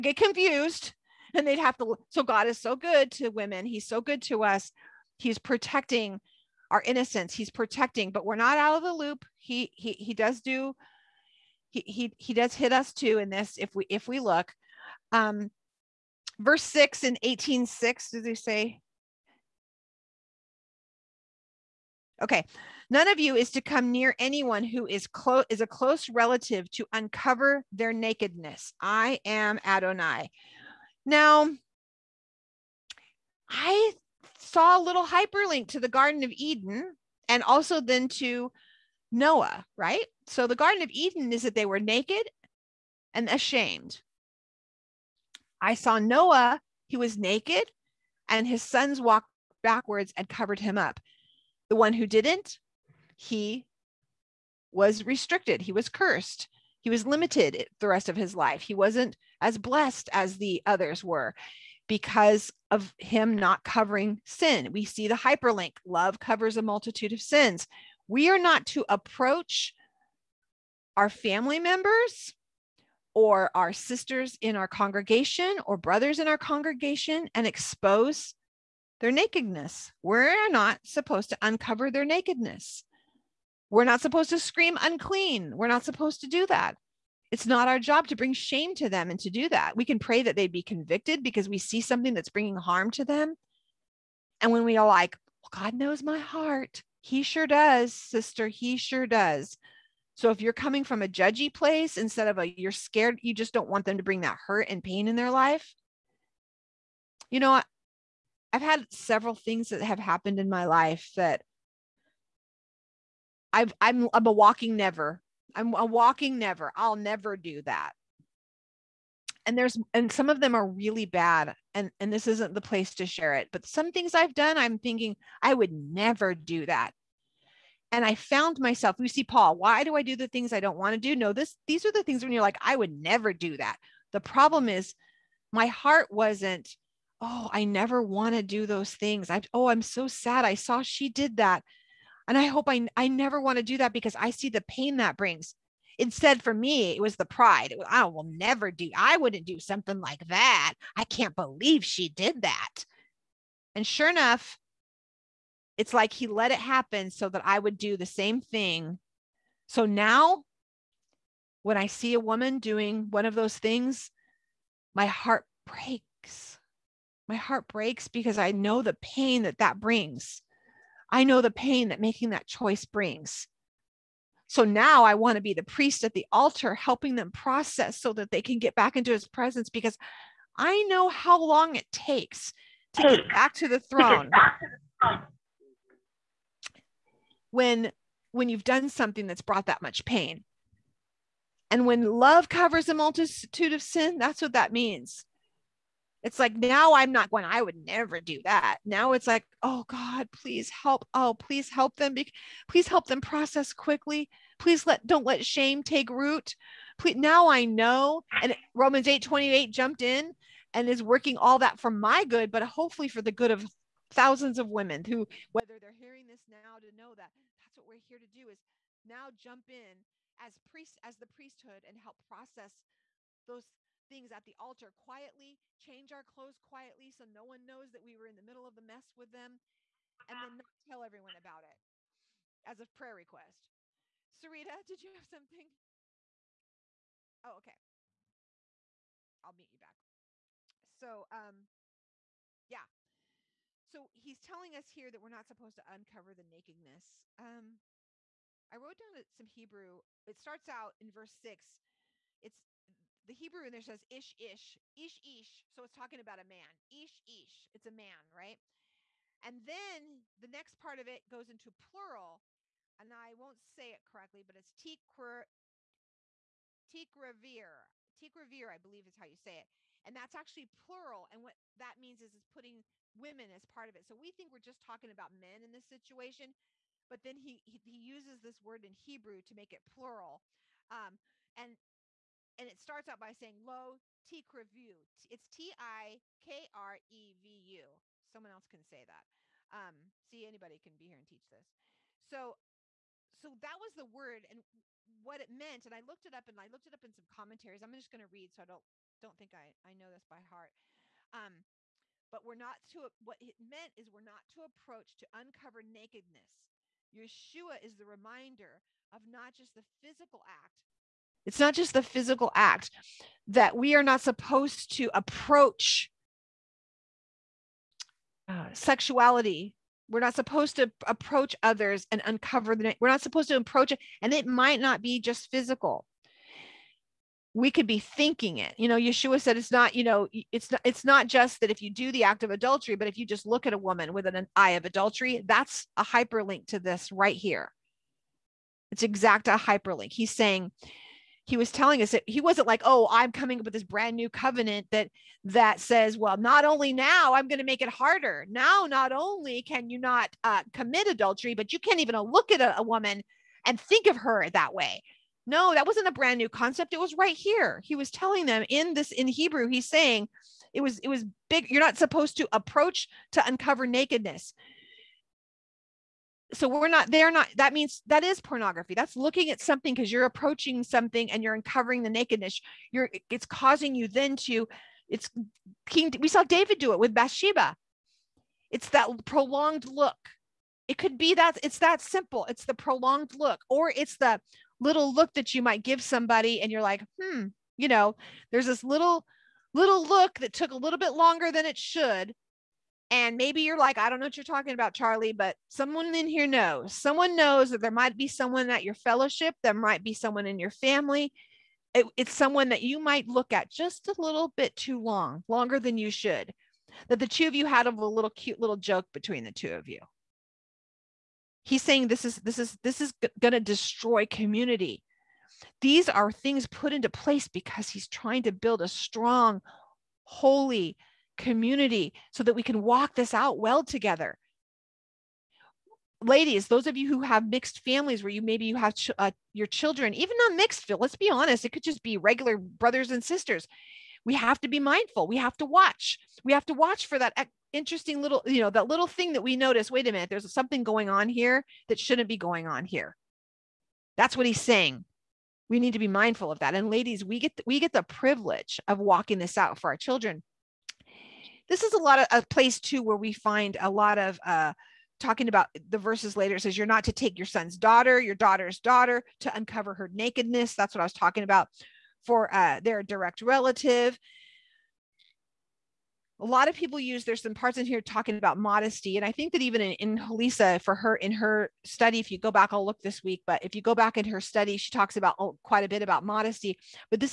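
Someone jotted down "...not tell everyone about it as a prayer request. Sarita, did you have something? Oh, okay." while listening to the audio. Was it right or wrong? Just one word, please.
right.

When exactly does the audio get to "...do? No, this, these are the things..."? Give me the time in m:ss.
2:10.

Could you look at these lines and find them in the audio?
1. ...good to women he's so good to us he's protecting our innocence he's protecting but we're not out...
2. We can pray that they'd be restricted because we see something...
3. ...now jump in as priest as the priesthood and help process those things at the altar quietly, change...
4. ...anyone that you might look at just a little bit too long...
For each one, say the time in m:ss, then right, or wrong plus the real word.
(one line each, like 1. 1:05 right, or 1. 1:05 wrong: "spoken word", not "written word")
1. 0:02 right
2. 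1:29 wrong: "convicted", not "restricted"
3. 3:39 right
4. 6:42 wrong: "someone", not "anyone".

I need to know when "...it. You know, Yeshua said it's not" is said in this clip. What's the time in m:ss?
5:28.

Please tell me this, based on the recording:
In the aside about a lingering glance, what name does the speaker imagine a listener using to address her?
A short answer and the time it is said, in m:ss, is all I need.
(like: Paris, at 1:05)
Charlie, at 6:34.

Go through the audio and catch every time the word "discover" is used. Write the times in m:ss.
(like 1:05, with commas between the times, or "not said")
not said.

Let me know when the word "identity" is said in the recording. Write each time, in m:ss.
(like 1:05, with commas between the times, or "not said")
not said.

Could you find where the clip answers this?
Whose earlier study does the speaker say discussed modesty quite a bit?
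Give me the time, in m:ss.
7:50.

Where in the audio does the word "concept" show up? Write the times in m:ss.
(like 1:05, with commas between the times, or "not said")
5:56.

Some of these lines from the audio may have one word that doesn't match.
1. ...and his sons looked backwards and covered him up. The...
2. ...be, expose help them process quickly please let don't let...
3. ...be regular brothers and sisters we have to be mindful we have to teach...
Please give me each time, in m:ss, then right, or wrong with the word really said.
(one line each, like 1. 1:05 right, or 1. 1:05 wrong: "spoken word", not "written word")
1. 0:48 wrong: "walked", not "looked"
2. 3:22 wrong: "please", not "expose"
3. 7:12 wrong: "watch", not "teach".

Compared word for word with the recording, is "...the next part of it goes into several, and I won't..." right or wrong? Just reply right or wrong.
wrong.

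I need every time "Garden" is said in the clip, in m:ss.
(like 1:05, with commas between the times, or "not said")
0:35, 0:40.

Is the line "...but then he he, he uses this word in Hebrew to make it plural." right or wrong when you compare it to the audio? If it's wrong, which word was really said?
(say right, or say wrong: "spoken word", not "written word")
right.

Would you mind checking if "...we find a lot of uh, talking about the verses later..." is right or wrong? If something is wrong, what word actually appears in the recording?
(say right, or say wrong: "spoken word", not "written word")
right.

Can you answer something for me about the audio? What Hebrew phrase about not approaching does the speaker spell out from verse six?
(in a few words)
low tikrevu.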